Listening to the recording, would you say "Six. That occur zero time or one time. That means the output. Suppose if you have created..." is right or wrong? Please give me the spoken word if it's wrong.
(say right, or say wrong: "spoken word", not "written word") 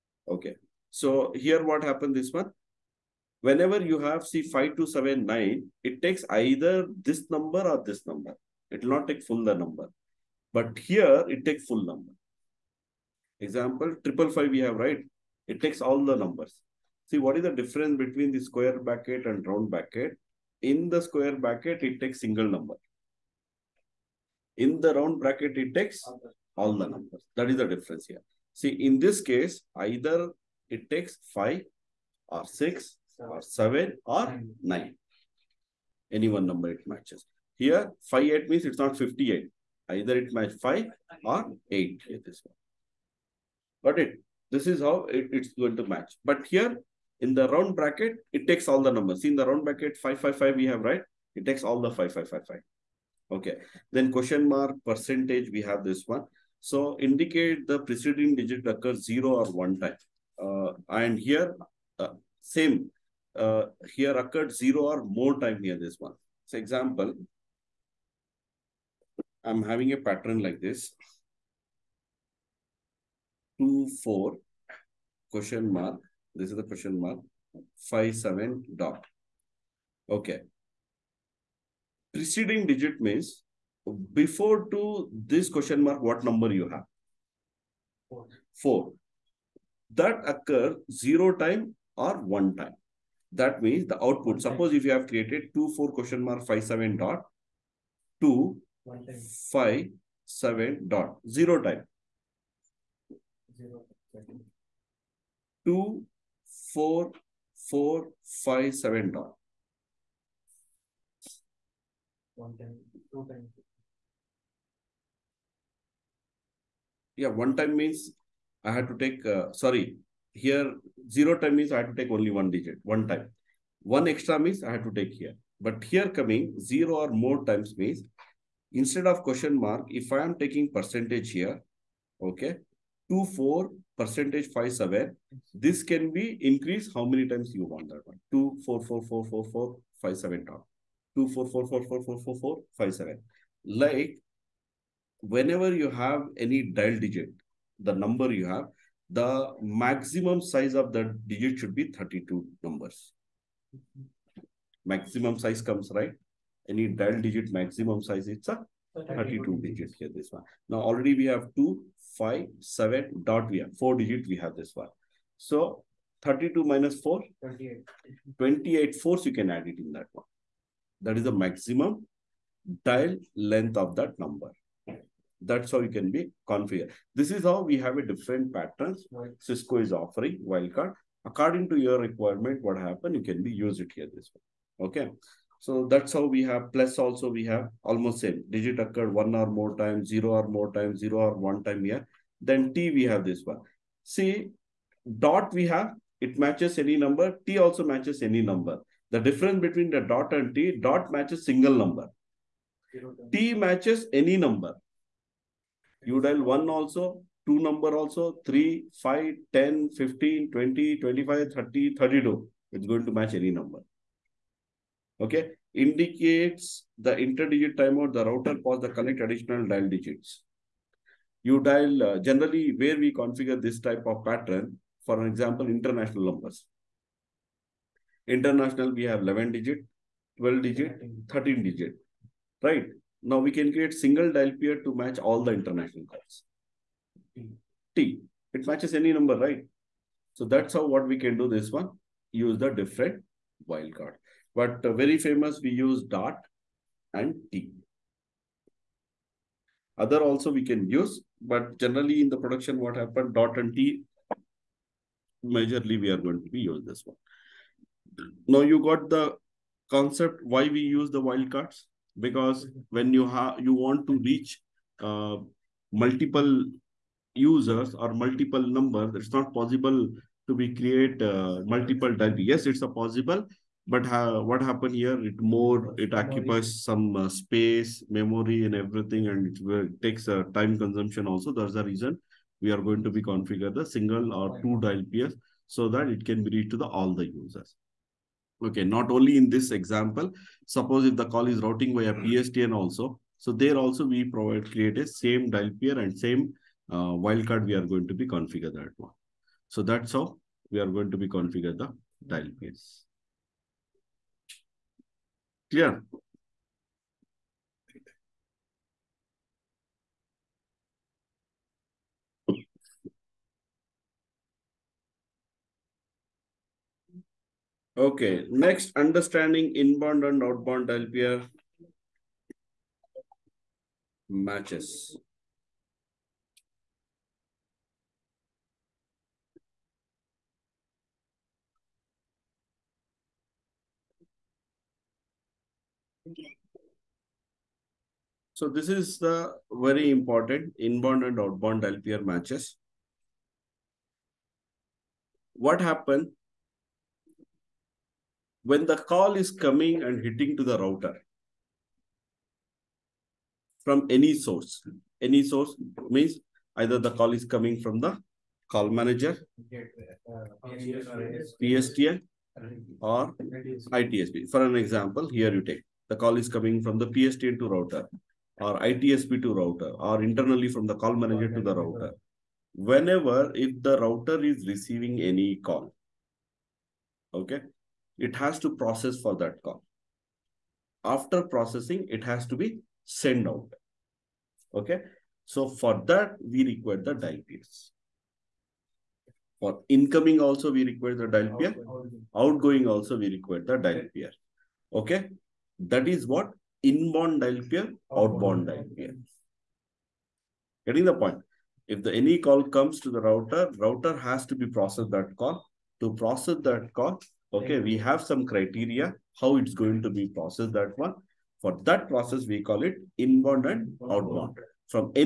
wrong: "Four", not "Six".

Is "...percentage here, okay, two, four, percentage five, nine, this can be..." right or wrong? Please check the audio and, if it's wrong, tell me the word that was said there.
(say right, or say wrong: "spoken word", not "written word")
wrong: "seven", not "nine".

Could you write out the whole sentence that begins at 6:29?
For incoming also, we require the dial peer.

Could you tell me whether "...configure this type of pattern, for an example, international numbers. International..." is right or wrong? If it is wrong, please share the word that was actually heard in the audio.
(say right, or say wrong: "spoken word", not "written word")
right.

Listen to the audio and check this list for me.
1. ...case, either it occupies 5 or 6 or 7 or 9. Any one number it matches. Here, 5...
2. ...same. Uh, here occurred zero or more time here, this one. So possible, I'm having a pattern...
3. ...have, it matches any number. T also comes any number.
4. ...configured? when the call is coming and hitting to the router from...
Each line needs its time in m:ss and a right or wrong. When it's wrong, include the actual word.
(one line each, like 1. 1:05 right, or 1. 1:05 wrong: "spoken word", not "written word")
1. 0:29 wrong: "takes", not "occupies"
2. 1:02 wrong: "example", not "possible"
3. 3:15 wrong: "matches", not "comes"
4. 5:45 wrong: "happened", not "configured".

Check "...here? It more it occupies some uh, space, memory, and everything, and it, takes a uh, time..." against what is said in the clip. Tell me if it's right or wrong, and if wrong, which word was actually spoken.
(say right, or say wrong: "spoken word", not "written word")
right.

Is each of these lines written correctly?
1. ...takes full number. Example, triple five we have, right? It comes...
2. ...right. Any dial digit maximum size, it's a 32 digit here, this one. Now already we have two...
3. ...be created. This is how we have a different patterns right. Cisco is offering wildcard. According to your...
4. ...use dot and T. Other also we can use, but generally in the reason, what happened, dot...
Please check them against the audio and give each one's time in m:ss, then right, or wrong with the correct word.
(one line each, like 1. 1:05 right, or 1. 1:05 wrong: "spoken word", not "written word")
1. 0:11 wrong: "takes", not "comes"
2. 2:35 right
3. 2:56 wrong: "configured", not "created"
4. 4:05 wrong: "production", not "reason".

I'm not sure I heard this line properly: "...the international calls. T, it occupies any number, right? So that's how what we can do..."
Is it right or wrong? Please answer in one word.
wrong.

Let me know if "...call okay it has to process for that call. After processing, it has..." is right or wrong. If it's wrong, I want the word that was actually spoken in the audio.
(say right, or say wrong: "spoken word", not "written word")
right.